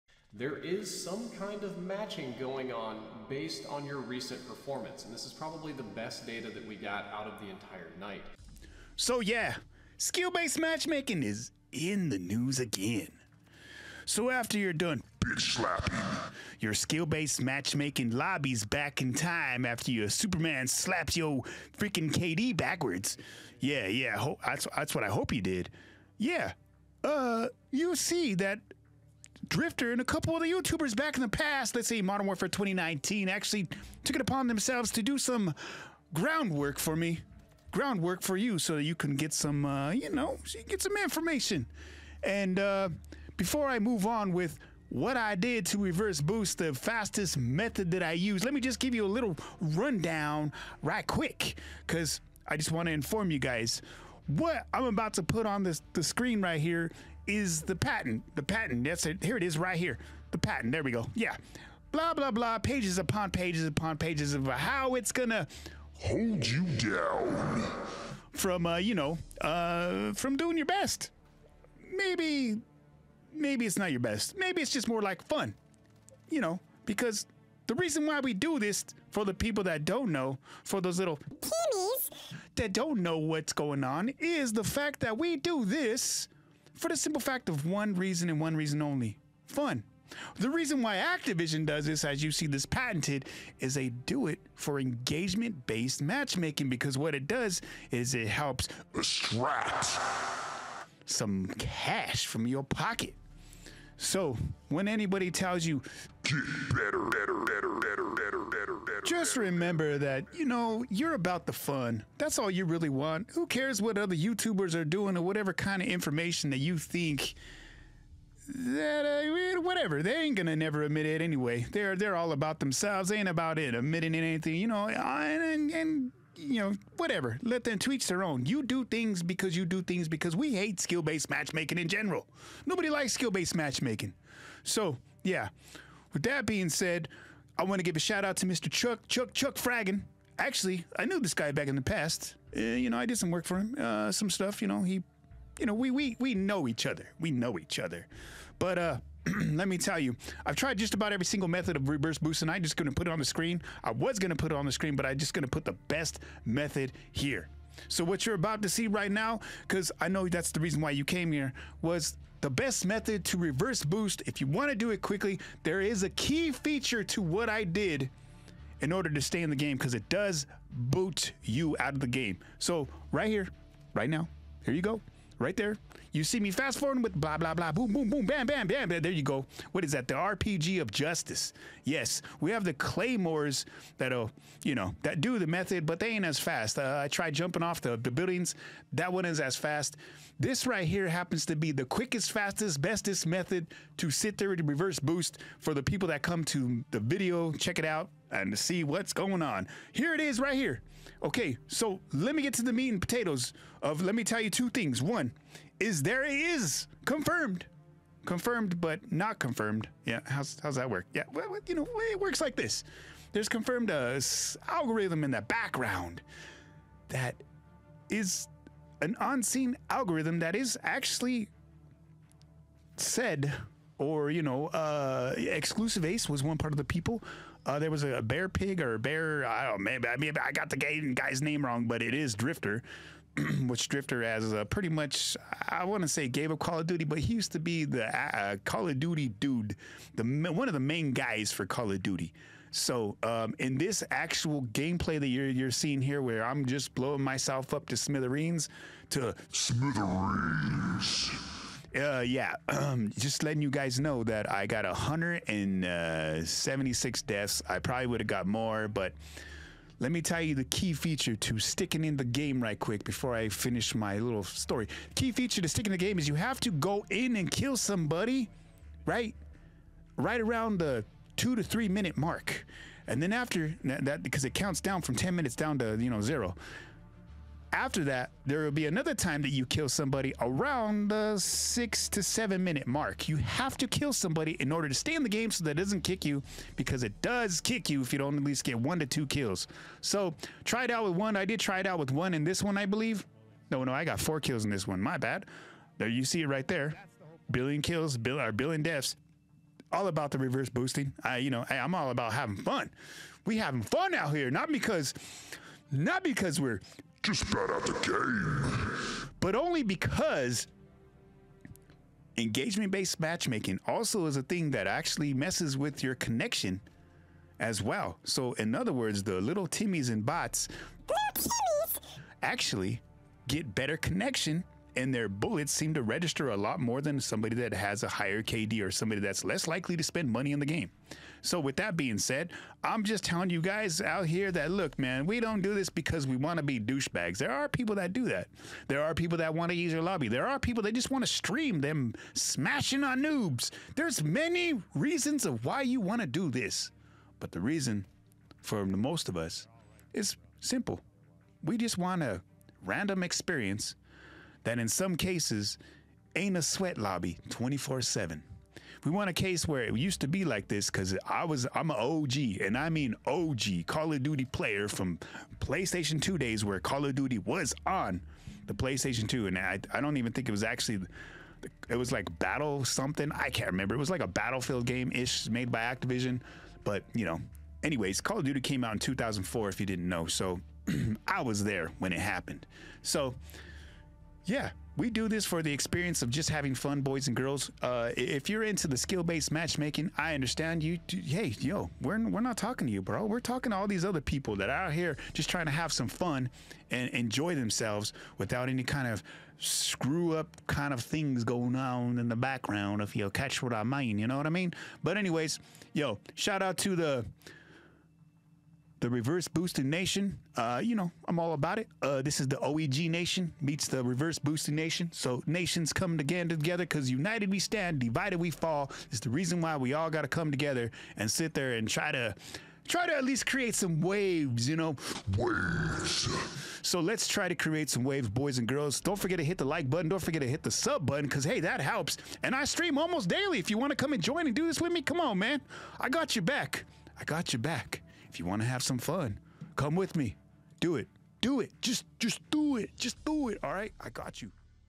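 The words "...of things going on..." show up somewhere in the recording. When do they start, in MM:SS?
06:40.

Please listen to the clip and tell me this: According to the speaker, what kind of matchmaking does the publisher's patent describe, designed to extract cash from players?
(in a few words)
Engagement based matchmaking.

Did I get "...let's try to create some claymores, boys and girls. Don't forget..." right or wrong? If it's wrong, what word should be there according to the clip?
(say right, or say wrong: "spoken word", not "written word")
wrong: "waves", not "claymores".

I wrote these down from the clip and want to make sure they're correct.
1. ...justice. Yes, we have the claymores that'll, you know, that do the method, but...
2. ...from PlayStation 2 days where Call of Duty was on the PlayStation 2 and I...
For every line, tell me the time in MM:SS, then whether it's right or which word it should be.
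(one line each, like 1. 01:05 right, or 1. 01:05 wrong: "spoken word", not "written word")
1. 03:00 right
2. 06:04 right.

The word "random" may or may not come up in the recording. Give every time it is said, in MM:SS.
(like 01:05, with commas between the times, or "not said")
05:52.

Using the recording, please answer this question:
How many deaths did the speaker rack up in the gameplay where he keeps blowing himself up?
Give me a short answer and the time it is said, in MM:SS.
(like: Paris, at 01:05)
176, at 04:14.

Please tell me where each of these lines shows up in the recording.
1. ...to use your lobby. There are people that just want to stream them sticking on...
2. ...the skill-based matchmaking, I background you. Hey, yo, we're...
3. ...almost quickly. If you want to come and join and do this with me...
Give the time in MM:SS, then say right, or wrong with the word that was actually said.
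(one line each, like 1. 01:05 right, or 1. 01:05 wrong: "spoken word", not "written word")
1. 05:39 wrong: "smashing", not "sticking"
2. 06:28 wrong: "understand", not "background"
3. 07:12 wrong: "daily", not "quickly".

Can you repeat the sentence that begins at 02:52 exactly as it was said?
So right here, right now, here you go.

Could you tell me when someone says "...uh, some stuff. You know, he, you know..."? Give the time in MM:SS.
02:23.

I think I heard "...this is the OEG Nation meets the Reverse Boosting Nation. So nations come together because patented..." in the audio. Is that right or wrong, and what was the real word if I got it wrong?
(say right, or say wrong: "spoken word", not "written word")
wrong: "united", not "patented".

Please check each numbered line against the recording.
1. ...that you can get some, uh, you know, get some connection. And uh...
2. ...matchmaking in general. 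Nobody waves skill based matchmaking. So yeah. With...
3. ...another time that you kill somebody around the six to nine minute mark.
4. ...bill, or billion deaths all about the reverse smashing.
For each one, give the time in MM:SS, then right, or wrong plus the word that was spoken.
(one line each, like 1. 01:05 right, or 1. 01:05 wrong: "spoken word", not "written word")
1. 00:38 wrong: "information", not "connection"
2. 02:11 wrong: "likes", not "waves"
3. 04:38 wrong: "seven", not "nine"
4. 04:58 wrong: "boosting", not "smashing".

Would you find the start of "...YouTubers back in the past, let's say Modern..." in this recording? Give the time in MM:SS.
00:30.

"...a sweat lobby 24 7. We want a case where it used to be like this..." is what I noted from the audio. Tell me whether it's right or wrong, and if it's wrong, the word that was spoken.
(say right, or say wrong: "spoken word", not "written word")
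right.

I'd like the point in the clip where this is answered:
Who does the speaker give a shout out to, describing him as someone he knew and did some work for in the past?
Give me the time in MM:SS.
02:19.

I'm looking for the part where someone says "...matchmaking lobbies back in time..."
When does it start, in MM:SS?
00:17.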